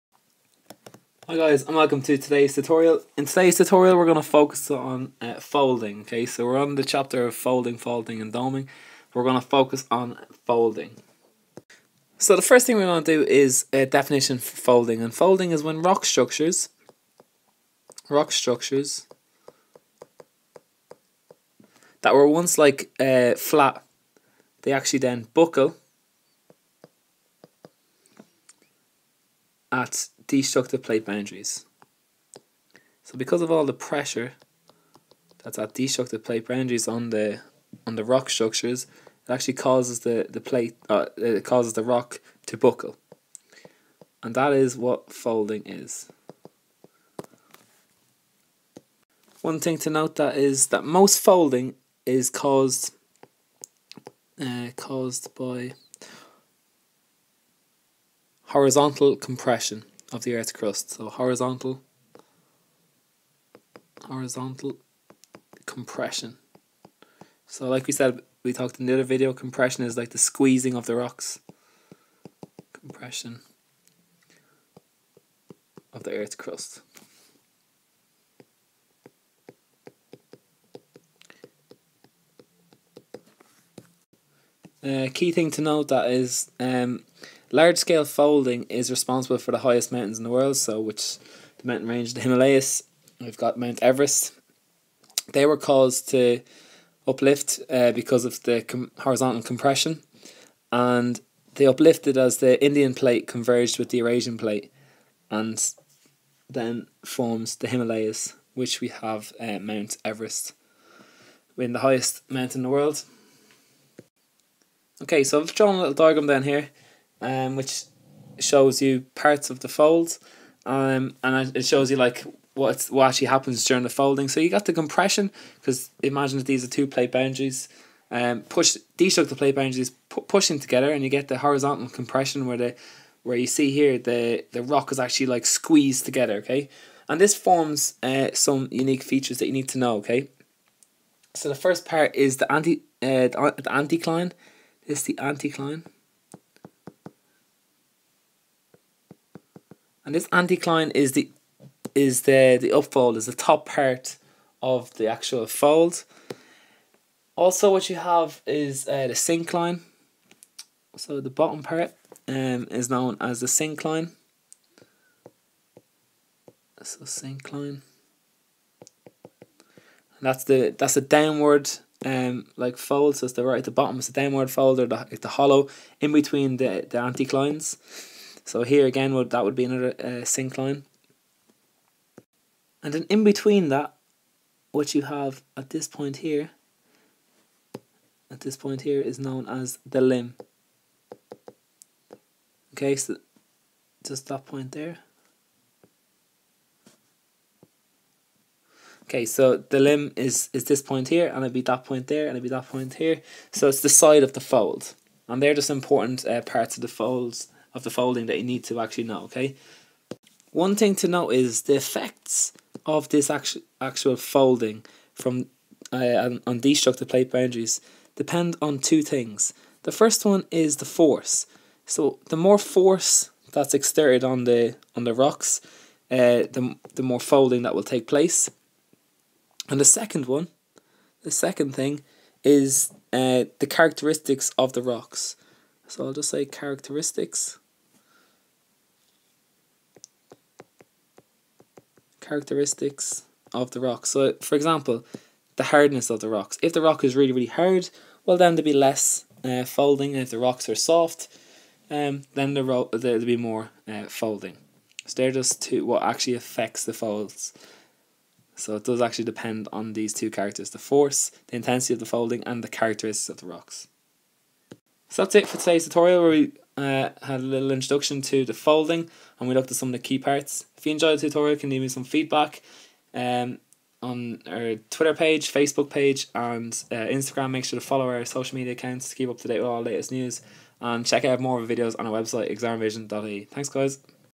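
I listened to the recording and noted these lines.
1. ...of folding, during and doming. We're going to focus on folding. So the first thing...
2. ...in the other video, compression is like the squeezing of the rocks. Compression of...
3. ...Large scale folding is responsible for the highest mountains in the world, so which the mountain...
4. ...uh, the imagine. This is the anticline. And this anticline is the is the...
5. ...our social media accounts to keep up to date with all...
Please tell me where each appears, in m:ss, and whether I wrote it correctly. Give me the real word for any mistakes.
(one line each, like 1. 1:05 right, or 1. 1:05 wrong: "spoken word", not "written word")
1. 0:07 wrong: "folding", not "during"
2. 1:08 right
3. 1:27 right
4. 2:23 wrong: "anticline", not "imagine"
5. 4:38 right.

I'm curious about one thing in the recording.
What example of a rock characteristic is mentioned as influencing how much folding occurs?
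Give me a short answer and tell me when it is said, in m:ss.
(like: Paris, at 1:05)
Hardness, at 4:05.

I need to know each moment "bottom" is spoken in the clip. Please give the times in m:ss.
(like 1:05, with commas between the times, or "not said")
2:41, 2:53.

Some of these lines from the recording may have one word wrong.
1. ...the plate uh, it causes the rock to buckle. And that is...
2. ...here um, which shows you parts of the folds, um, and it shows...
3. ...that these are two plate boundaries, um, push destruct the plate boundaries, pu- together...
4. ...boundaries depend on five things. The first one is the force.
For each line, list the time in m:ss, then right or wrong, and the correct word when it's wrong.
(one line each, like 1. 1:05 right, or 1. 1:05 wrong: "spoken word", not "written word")
1. 0:40 right
2. 1:56 right
3. 2:06 right
4. 3:37 wrong: "two", not "five".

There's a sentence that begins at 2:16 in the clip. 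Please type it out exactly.
Okay, and this forms uh, some unique features that you need to know.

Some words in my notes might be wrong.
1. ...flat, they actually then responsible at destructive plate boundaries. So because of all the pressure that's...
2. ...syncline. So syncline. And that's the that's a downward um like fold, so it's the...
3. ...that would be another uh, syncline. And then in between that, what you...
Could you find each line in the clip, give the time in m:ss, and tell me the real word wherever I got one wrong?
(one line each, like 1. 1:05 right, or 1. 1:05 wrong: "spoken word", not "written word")
1. 0:23 wrong: "buckle", not "responsible"
2. 2:43 right
3. 2:59 right.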